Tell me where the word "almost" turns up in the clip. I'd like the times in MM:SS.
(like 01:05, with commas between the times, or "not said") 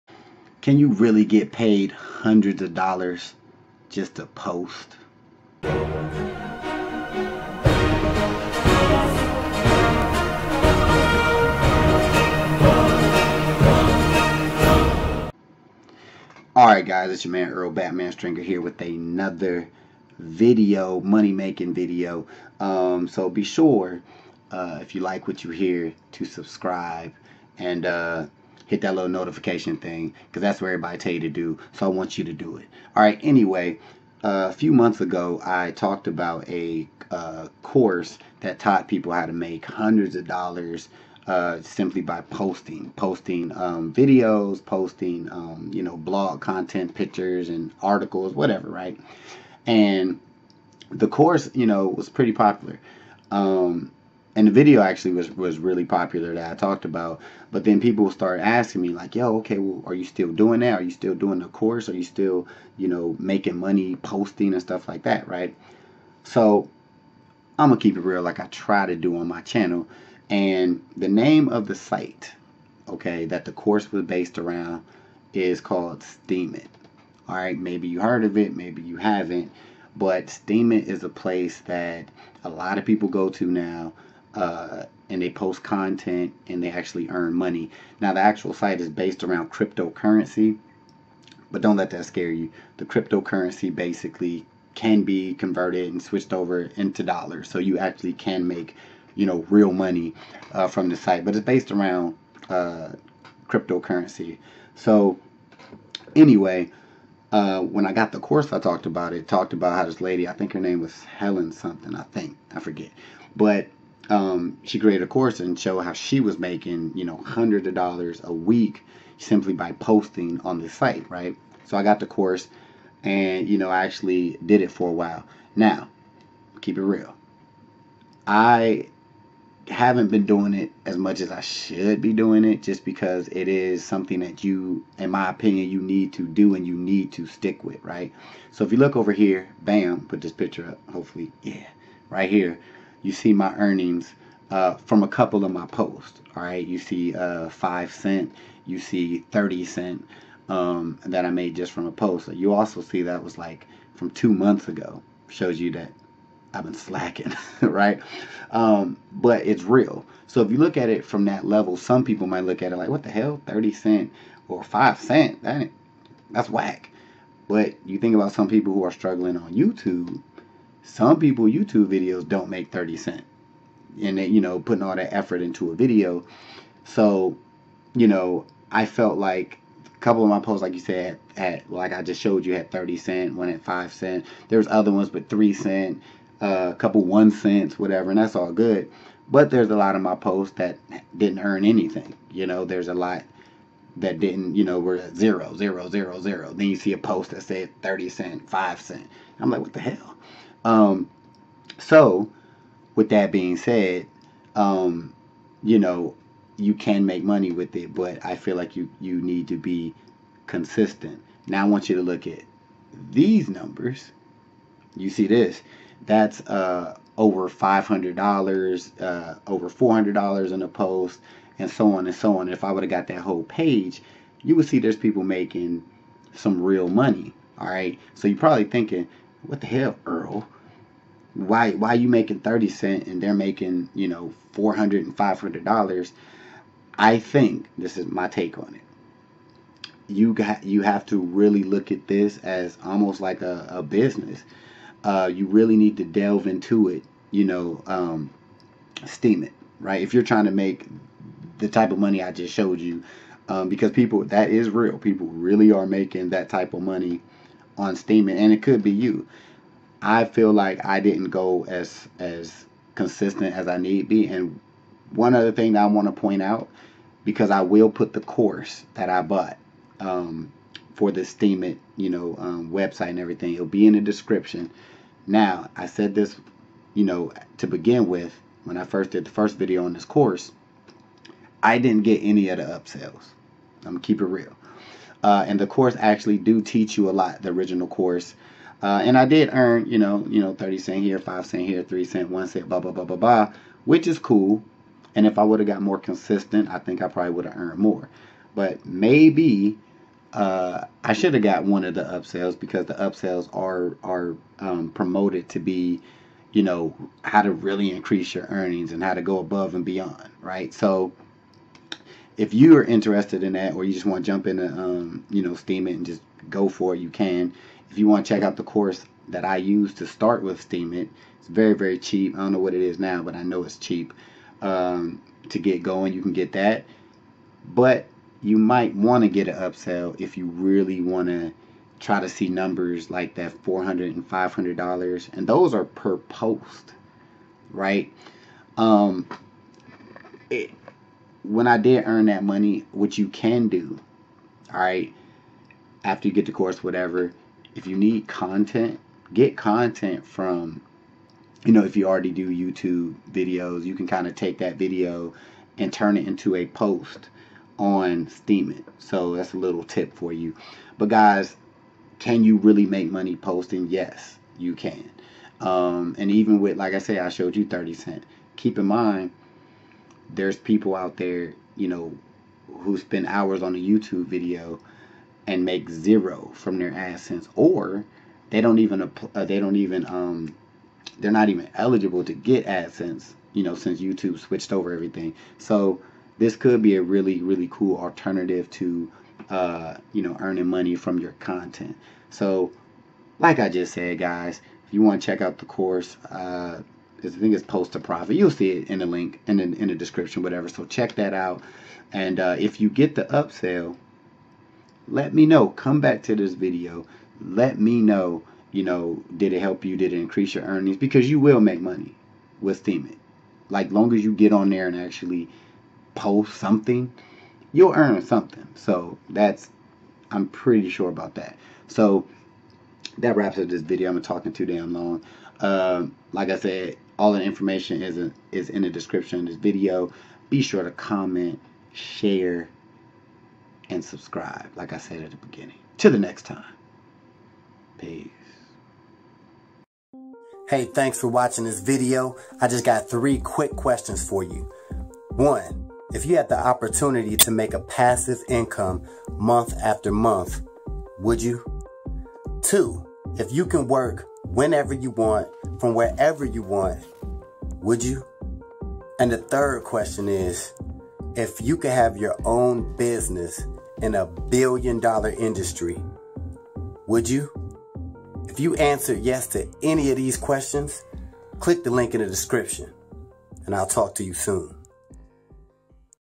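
04:02.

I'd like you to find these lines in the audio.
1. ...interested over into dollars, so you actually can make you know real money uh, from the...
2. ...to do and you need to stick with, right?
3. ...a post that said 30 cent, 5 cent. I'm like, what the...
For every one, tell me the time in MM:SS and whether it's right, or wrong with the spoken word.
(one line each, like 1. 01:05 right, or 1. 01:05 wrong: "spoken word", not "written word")
1. 01:36 wrong: "switched", not "interested"
2. 02:16 right
3. 03:16 right.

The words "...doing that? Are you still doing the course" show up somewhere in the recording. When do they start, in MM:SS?
01:00.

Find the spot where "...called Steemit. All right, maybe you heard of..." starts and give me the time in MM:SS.
01:15.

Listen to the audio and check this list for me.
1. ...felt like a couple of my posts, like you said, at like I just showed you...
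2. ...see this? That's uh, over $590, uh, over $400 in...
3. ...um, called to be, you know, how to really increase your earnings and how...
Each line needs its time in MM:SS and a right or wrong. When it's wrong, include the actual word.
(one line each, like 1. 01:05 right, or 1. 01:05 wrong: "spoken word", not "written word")
1. 02:58 right
2. 03:35 wrong: "500", not "590"
3. 05:04 wrong: "promoted", not "called".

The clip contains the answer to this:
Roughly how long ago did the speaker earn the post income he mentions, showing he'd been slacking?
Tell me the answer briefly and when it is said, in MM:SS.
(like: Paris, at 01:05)
2 months, at 02:34.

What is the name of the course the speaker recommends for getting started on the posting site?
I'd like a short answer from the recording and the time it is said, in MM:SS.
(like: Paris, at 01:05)
Post 2 Profit, at 06:37.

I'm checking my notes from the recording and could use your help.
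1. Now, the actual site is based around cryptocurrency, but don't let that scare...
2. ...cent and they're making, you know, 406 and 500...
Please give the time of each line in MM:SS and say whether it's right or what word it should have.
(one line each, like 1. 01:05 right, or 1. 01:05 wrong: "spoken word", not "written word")
1. 01:27 right
2. 03:52 wrong: "400", not "406".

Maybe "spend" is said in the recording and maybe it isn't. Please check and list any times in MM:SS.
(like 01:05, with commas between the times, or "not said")
06:12.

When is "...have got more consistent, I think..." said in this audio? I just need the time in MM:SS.
04:55.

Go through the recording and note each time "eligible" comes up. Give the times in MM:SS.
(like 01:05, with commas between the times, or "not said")
06:21.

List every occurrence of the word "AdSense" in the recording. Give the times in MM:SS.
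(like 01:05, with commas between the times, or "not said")
06:16, 06:22.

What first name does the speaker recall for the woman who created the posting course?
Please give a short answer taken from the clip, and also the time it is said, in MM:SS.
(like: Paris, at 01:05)
Helen, at 01:51.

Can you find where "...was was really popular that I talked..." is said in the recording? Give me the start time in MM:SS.
00:55.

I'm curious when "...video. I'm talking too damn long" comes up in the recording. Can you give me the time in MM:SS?
07:03.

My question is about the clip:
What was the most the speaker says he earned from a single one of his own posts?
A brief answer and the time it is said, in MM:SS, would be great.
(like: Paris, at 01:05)
30 cents, at 02:29.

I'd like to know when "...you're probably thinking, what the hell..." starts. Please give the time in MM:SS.
03:48.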